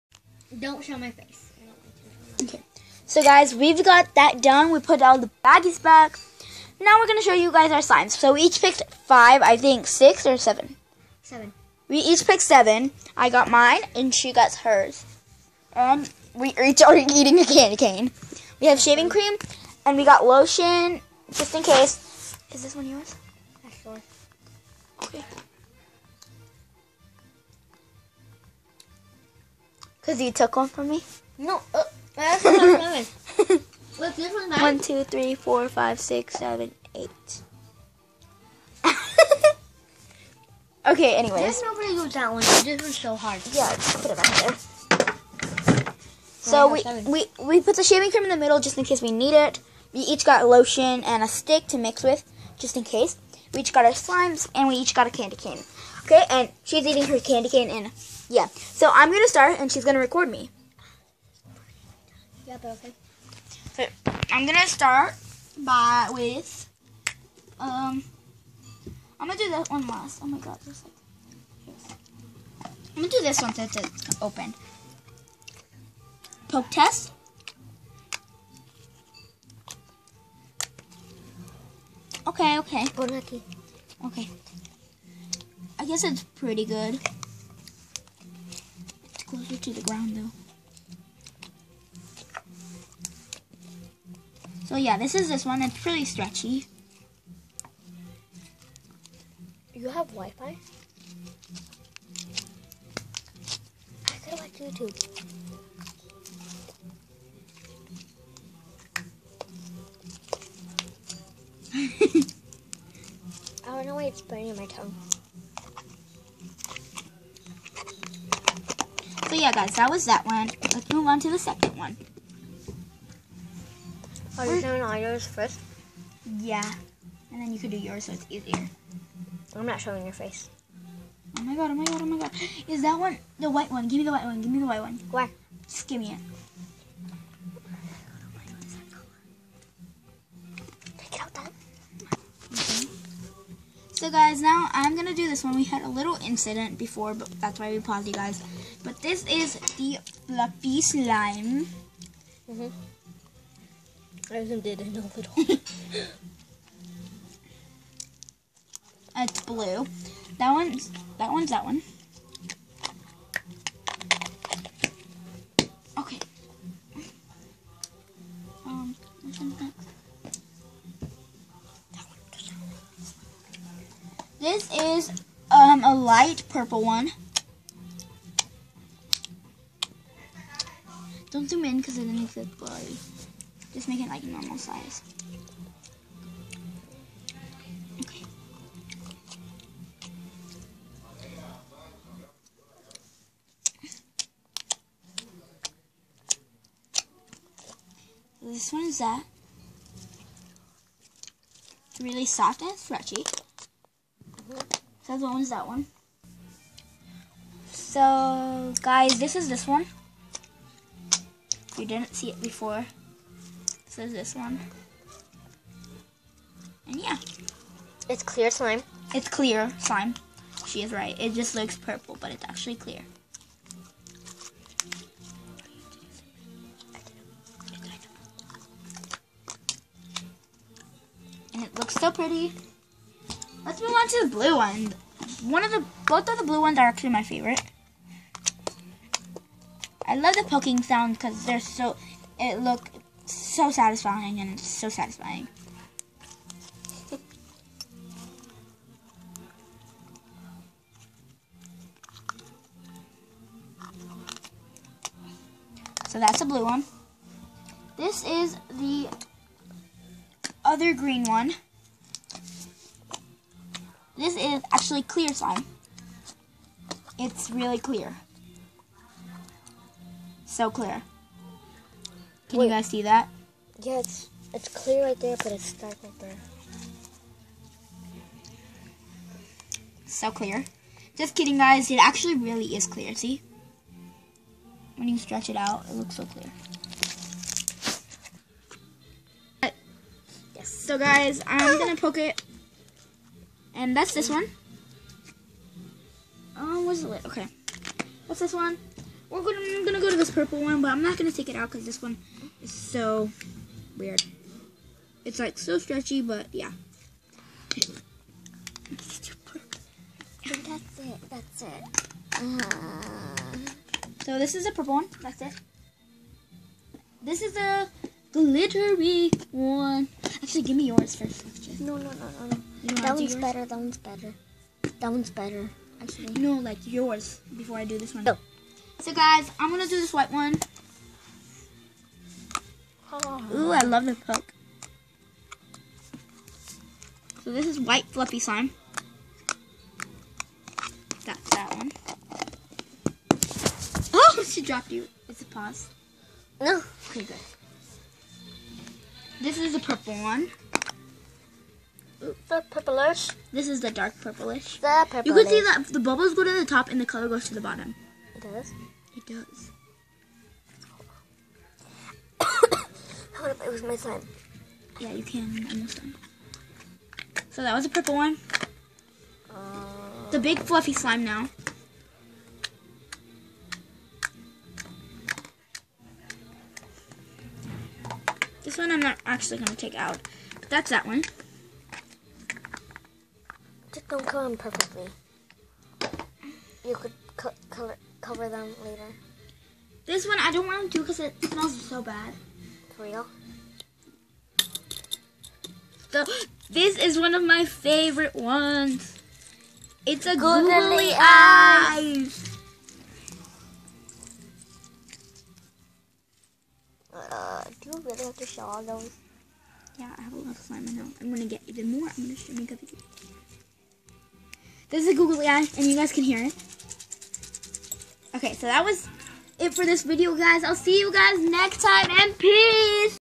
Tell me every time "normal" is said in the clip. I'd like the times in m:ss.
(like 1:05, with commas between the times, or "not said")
3:04.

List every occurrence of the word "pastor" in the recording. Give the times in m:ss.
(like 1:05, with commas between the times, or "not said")
not said.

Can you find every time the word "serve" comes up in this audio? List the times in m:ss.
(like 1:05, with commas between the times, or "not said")
not said.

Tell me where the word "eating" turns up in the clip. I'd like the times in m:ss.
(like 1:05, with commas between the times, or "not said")
0:16, 0:56.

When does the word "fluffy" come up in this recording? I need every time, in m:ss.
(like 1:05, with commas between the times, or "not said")
2:30, 5:38, 6:10.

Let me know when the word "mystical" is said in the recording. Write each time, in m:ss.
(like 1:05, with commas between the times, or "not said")
not said.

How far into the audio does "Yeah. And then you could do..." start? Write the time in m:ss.
2:06.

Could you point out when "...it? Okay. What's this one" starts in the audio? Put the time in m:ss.
4:57.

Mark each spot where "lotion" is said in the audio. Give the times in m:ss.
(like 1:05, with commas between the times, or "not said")
0:20, 0:50.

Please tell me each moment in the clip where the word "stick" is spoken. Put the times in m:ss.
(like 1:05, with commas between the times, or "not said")
0:51.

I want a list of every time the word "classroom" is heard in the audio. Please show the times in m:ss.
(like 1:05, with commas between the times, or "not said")
not said.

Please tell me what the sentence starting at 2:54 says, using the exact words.
This is um, a light purple one.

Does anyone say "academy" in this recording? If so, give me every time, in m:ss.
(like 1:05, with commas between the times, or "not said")
not said.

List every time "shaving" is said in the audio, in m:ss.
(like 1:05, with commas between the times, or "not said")
0:18, 0:47.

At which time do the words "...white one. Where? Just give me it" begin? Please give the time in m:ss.
2:14.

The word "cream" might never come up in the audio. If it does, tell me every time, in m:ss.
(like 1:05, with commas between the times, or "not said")
0:19, 0:48.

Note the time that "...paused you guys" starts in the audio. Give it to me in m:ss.
2:27.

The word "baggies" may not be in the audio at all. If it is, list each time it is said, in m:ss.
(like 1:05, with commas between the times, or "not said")
0:05.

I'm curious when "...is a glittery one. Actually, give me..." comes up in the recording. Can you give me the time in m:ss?
5:17.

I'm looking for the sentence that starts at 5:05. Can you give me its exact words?
It's like so stretchy, but yeah.